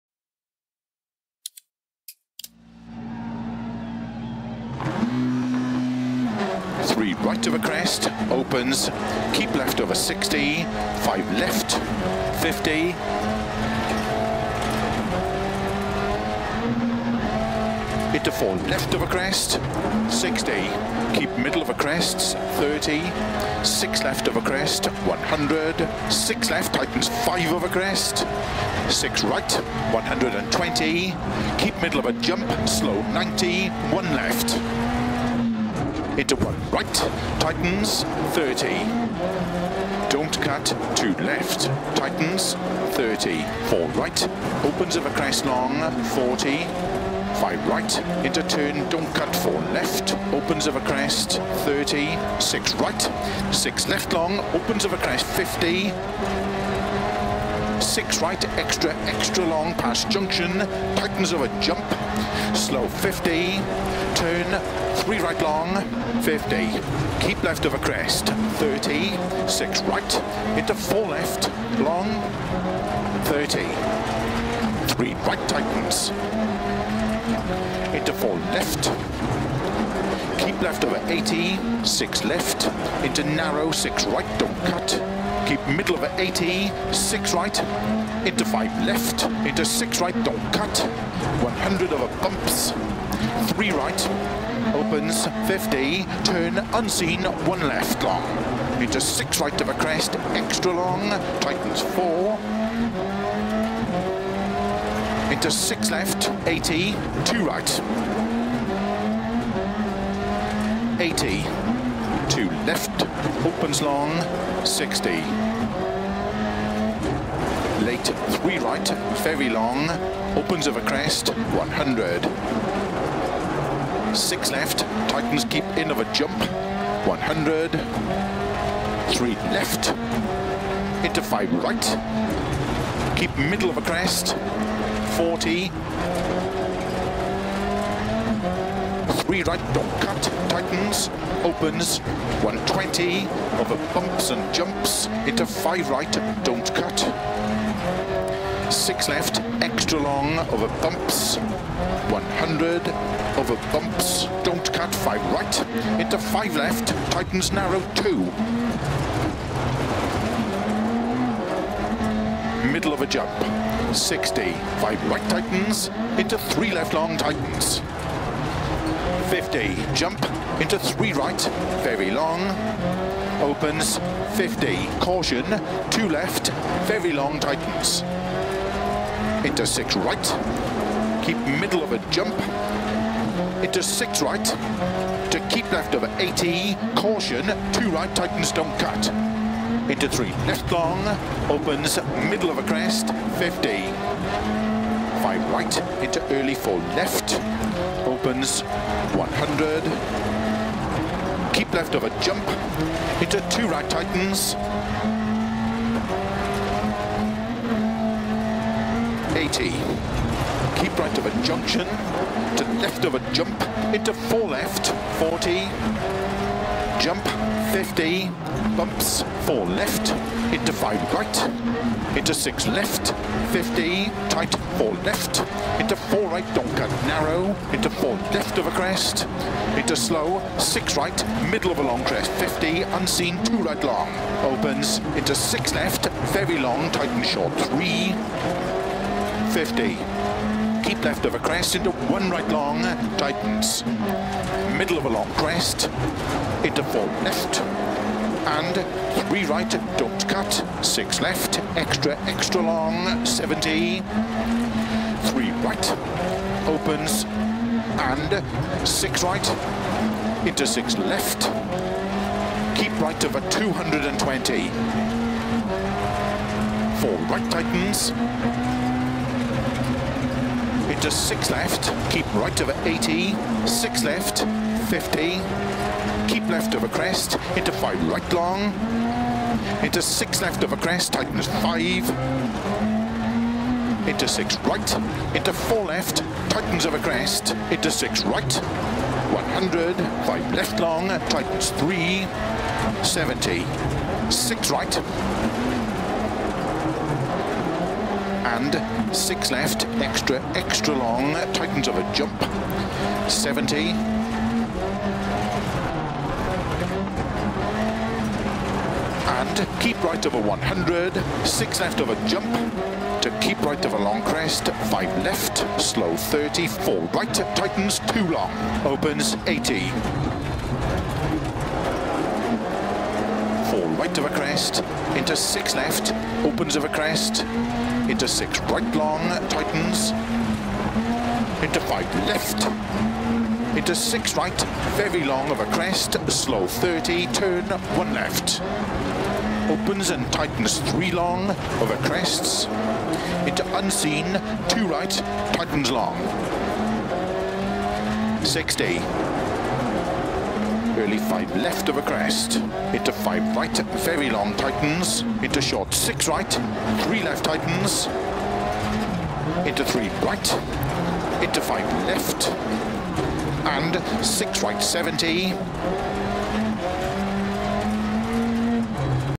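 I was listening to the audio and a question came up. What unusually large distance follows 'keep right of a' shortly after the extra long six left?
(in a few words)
220.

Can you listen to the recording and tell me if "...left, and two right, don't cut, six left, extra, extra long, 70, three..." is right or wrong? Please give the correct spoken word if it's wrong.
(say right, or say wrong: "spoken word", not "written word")
wrong: "three", not "two".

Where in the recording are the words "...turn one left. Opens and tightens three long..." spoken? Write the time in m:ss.
5:37.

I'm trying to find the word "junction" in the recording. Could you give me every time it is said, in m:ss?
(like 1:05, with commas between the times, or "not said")
1:00, 3:31.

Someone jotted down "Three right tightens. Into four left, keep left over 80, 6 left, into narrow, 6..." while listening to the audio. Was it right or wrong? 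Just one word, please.
right.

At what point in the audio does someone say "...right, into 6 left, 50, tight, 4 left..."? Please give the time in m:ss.
3:41.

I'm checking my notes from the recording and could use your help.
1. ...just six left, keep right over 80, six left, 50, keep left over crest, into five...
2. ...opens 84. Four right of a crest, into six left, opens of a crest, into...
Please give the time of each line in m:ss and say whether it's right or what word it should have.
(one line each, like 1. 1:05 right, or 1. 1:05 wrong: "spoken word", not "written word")
1. 4:31 right
2. 5:18 wrong: "80", not "84".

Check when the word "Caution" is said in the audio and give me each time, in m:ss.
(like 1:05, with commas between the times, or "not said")
2:54, 3:06.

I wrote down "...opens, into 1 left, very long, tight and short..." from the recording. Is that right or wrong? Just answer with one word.
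wrong.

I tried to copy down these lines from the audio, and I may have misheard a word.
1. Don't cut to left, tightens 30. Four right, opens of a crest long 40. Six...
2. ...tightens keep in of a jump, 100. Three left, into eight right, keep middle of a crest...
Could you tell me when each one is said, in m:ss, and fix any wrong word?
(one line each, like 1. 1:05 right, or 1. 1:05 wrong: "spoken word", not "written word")
1. 0:40 wrong: "Five", not "Six"
2. 2:05 wrong: "five", not "eight".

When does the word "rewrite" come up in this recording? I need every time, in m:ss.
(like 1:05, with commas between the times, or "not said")
2:19.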